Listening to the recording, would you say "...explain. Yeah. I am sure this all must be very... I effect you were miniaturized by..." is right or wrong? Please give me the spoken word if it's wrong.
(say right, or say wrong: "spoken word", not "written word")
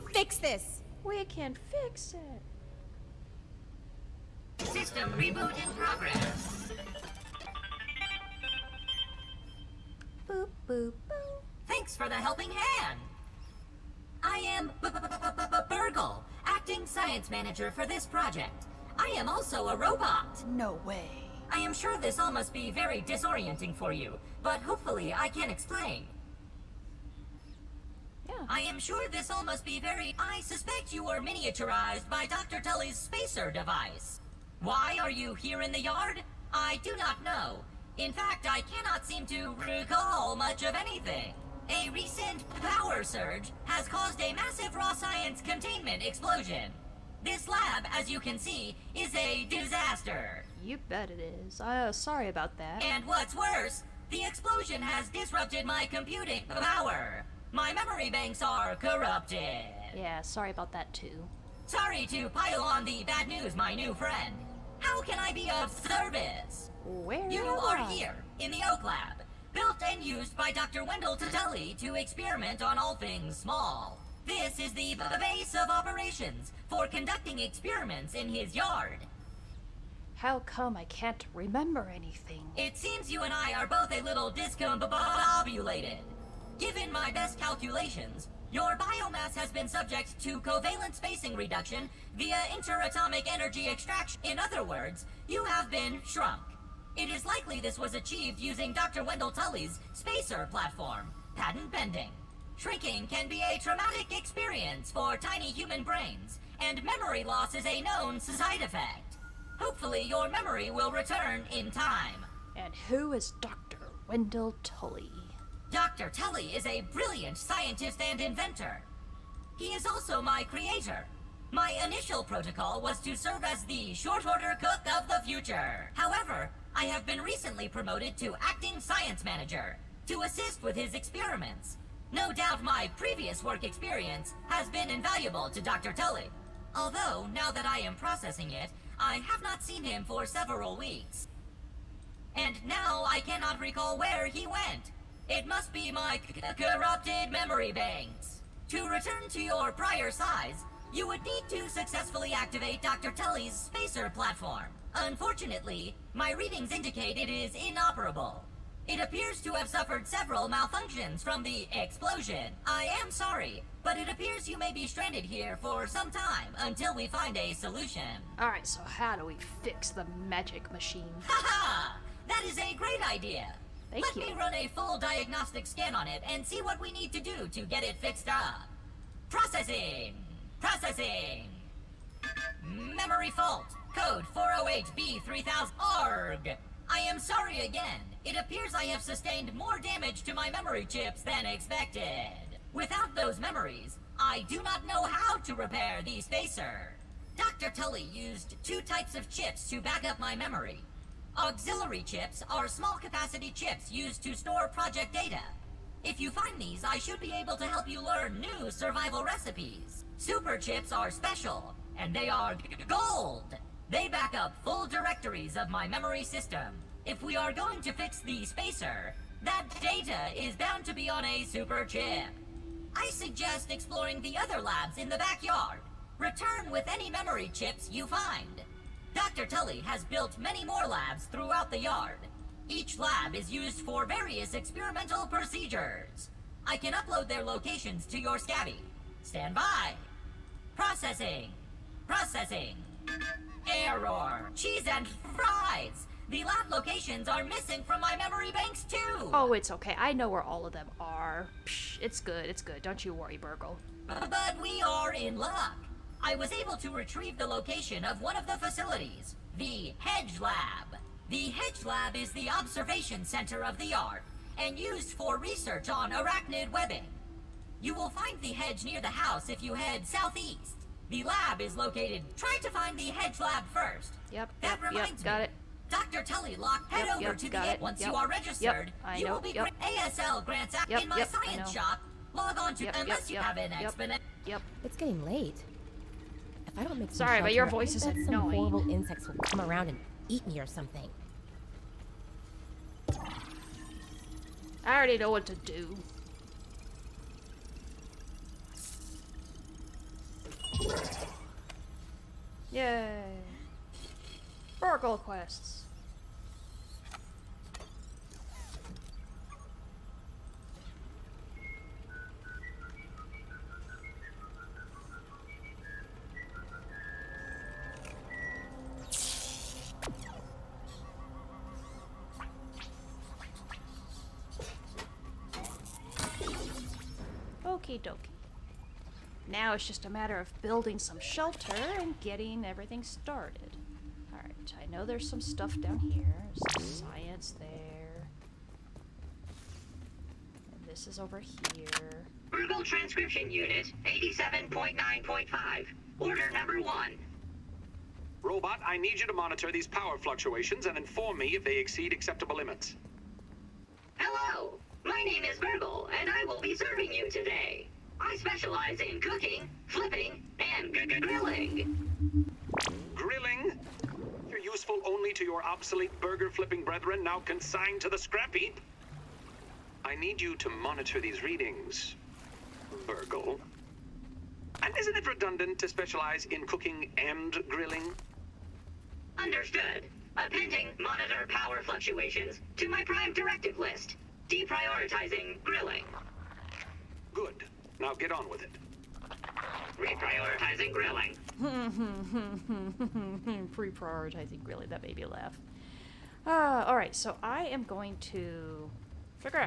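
wrong: "suspect", not "effect".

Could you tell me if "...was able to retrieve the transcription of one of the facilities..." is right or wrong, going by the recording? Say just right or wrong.
wrong.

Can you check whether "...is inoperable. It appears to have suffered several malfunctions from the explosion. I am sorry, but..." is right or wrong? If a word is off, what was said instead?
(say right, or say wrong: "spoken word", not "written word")
right.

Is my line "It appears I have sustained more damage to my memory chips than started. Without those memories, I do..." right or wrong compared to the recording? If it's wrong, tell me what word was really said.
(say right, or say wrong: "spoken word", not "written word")
wrong: "expected", not "started".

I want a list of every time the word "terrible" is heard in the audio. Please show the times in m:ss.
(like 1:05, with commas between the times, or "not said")
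not said.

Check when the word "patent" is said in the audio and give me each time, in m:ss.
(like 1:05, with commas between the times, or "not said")
1:41.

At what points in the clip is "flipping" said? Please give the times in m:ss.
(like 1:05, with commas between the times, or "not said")
5:59, 6:06.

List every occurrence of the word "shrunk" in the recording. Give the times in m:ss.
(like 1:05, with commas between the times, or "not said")
1:36.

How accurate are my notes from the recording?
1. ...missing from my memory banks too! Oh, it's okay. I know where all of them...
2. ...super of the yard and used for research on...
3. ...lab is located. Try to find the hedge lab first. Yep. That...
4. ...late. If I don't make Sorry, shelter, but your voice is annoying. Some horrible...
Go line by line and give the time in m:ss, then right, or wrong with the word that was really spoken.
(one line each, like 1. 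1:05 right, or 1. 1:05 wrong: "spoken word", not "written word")
1. 4:07 right
2. 4:23 wrong: "center", not "super"
3. 4:31 right
4. 4:45 right.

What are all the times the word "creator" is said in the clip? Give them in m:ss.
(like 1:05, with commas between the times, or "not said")
2:00.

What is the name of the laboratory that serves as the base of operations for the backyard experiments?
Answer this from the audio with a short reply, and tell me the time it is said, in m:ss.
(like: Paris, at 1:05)
Oak Lab, at 1:08.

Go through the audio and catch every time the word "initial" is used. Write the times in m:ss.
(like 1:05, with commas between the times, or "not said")
2:01.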